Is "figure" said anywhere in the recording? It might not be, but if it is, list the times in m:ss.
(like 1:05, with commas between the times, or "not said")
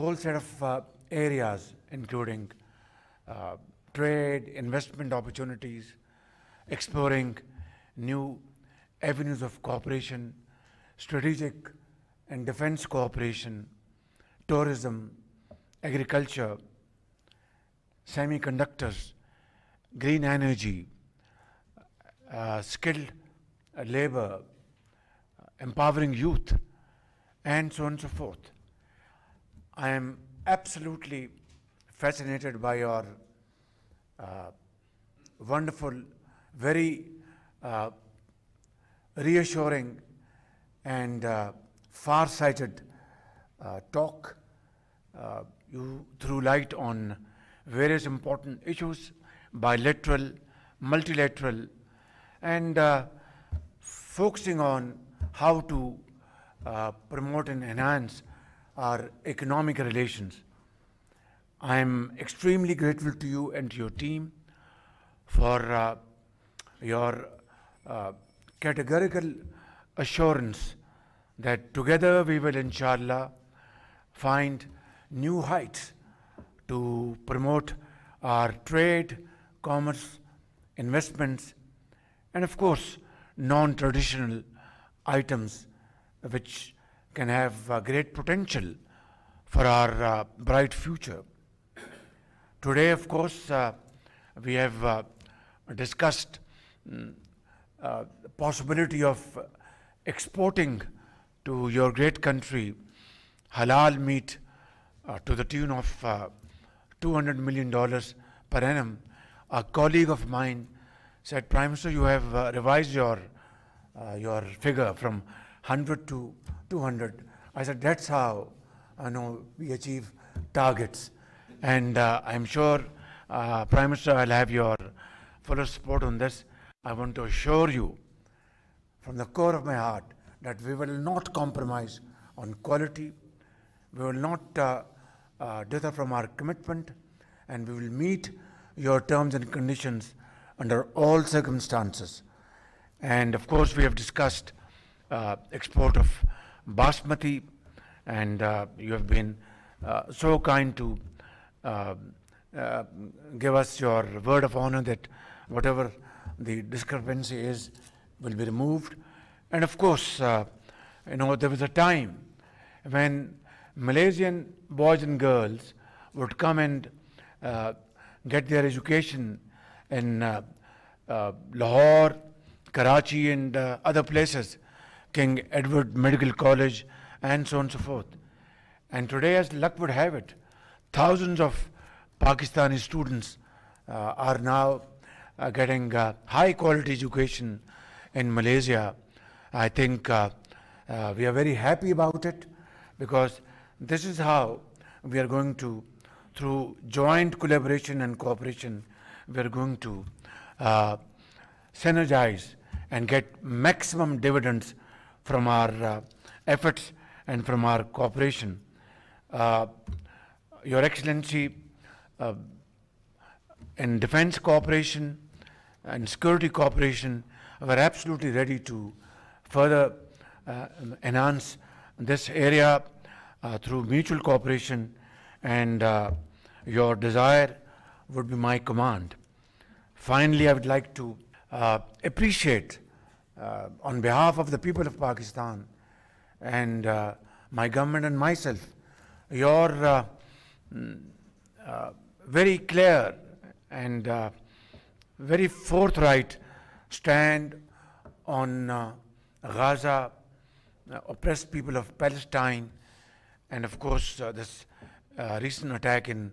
1:54.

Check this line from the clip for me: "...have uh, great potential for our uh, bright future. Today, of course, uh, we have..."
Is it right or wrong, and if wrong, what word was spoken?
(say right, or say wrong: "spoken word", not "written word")
right.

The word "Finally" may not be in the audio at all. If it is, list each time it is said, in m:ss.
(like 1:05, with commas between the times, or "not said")
3:50.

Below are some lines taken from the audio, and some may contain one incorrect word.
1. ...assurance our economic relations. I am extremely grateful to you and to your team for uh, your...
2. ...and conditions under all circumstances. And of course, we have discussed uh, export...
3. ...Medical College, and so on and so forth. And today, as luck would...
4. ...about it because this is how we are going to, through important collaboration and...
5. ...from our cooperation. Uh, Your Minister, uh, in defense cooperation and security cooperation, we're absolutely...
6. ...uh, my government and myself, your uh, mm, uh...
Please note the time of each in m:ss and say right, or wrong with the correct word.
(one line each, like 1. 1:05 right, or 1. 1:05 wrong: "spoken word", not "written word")
1. 0:57 wrong: "enhance", not "assurance"
2. 2:19 right
3. 2:55 right
4. 3:11 wrong: "joint", not "important"
5. 3:27 wrong: "Excellency", not "Minister"
6. 3:56 right.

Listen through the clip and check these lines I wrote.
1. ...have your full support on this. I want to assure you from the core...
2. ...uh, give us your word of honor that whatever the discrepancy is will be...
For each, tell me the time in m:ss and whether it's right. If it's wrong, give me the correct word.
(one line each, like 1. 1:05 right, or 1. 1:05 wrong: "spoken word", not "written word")
1. 2:04 right
2. 2:32 right.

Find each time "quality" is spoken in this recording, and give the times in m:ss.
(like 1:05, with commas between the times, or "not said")
2:12, 3:06.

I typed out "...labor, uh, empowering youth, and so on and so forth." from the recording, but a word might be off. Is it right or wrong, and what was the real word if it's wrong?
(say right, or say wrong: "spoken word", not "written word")
right.